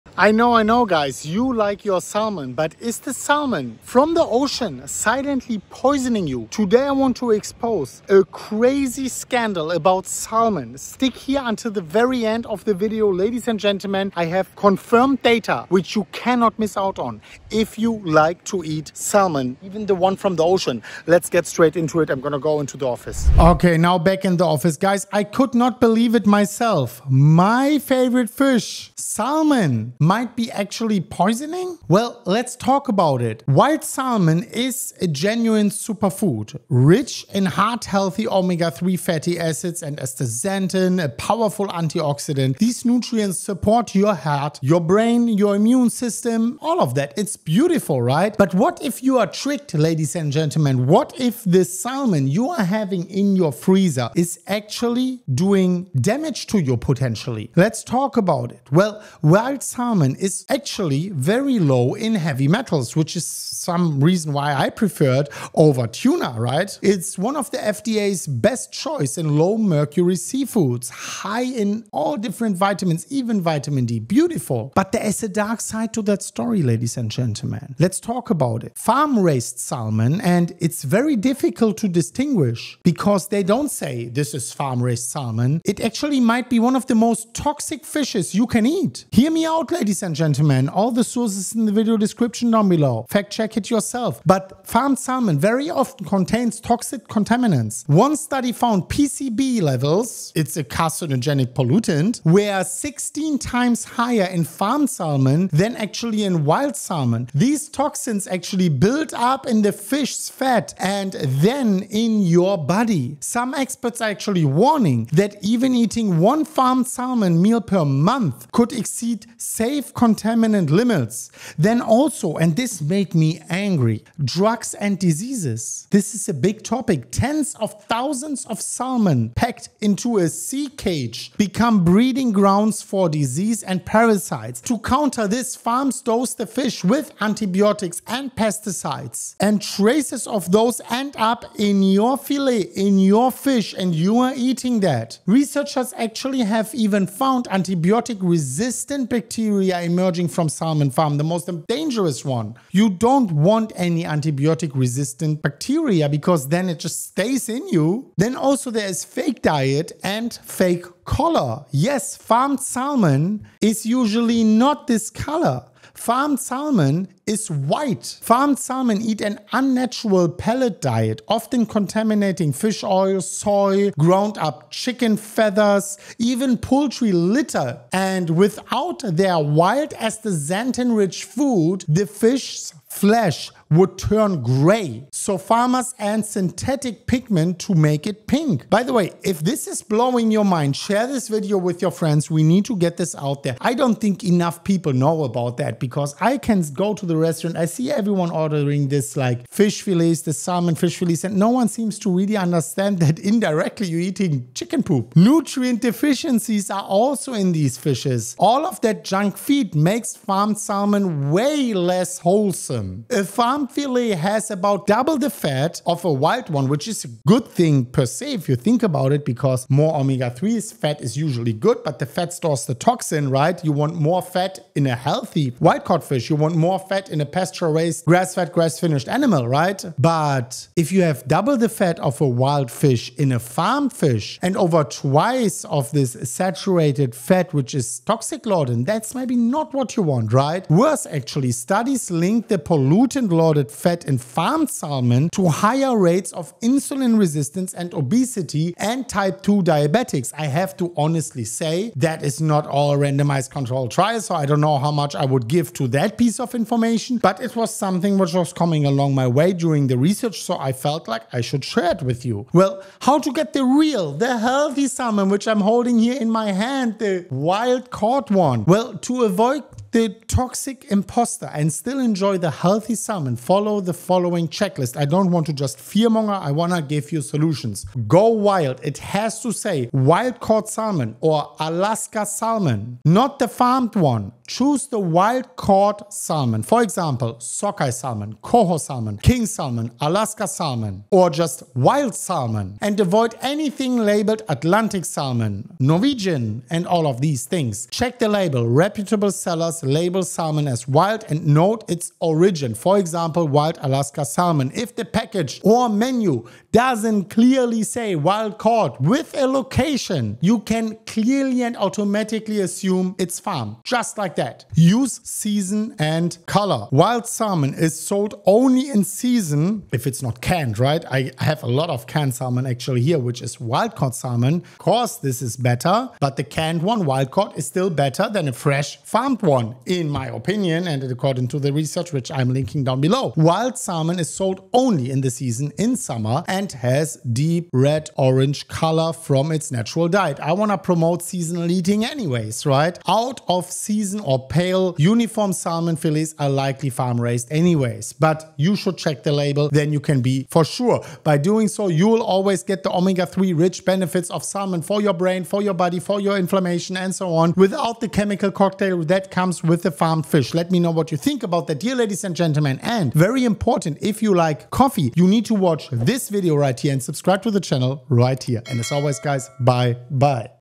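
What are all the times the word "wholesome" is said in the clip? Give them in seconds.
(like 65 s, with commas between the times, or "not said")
212 s.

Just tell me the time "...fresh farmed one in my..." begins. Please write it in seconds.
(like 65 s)
328 s.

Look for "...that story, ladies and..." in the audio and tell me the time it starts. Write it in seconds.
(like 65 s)
76 s.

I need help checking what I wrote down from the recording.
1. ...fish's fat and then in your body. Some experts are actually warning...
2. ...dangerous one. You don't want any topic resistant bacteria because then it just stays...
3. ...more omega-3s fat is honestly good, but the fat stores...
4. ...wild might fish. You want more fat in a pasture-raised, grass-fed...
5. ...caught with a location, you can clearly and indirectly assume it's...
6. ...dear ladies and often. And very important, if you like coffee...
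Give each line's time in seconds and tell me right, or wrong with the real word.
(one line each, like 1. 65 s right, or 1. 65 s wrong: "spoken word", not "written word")
1. 109 s right
2. 151 s wrong: "antibiotic", not "topic"
3. 219 s wrong: "usually", not "honestly"
4. 225 s wrong: "caught", not "might"
5. 308 s wrong: "automatically", not "indirectly"
6. 361 s wrong: "gentlemen", not "often".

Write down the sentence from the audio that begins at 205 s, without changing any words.
Nutrient deficiencies are also in these fishes.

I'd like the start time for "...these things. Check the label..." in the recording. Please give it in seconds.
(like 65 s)
297 s.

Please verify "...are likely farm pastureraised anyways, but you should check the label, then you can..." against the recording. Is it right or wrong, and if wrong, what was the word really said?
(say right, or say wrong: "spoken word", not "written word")
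wrong: "raised", not "pastureraised".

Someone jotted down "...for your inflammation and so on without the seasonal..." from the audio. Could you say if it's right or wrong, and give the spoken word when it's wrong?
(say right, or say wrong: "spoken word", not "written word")
wrong: "chemical", not "seasonal".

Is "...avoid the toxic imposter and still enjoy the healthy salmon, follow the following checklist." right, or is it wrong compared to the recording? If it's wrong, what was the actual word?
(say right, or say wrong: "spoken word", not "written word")
right.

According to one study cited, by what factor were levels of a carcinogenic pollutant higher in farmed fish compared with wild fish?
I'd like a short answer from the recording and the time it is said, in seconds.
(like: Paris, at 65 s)
16 times, at 102 s.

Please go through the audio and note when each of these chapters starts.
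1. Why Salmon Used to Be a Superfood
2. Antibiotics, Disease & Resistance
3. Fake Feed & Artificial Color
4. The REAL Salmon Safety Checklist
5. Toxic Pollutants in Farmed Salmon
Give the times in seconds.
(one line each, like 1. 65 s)
1. 59 s
2. 121 s
3. 158 s
4. 262 s
5. 74 s.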